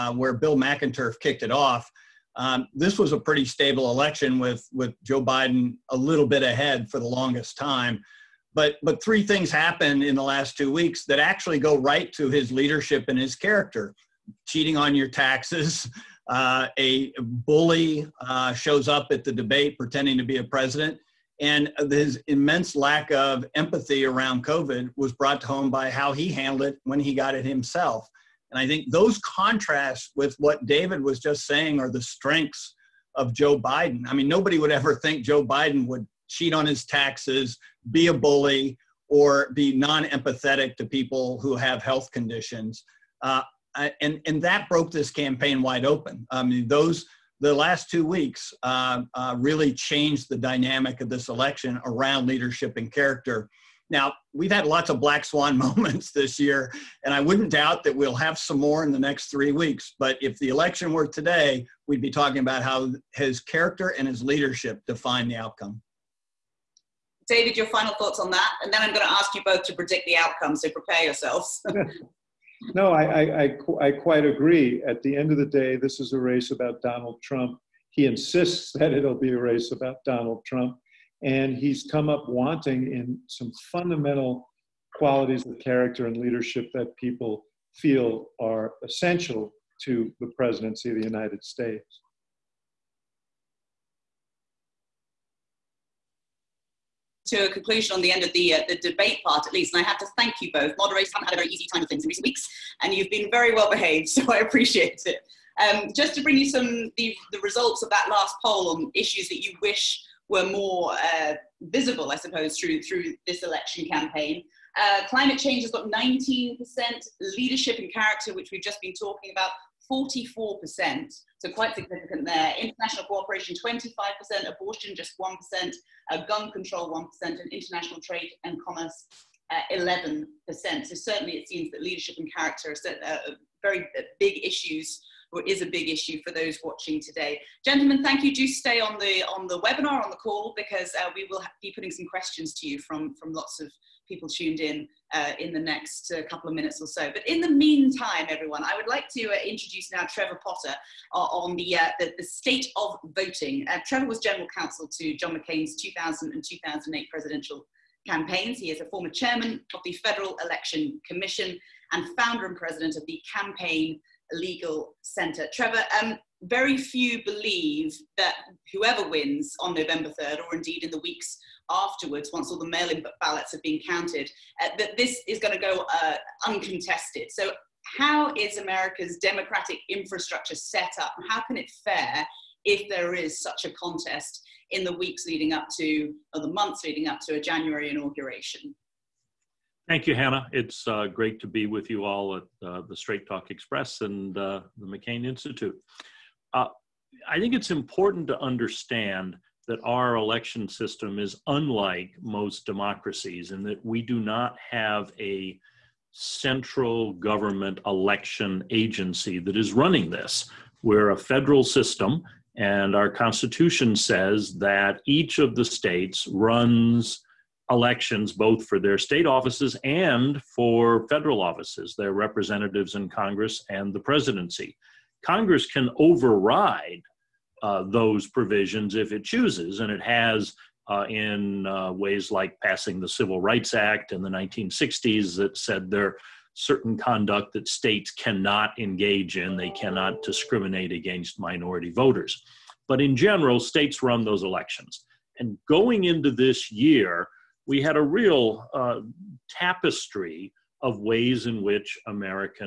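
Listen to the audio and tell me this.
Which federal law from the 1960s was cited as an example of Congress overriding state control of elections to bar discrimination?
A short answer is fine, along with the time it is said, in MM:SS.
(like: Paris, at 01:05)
Civil Rights Act, at 03:53.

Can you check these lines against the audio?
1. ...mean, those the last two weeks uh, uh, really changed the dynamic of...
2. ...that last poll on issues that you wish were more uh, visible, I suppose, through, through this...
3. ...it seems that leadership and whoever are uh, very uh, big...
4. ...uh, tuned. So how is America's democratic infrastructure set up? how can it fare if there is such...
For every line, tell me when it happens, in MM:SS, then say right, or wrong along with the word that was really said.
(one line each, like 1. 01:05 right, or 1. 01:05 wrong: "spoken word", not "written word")
1. 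00:46 right
2. 01:47 right
3. 02:11 wrong: "character", not "whoever"
4. 02:56 wrong: "uncontested", not "tuned".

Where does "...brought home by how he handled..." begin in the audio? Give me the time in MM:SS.
00:25.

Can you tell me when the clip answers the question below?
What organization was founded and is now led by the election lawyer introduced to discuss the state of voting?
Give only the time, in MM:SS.
02:43.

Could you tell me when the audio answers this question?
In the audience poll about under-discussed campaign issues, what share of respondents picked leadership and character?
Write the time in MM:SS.
01:59.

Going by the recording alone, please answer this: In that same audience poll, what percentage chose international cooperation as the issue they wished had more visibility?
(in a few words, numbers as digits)
25%.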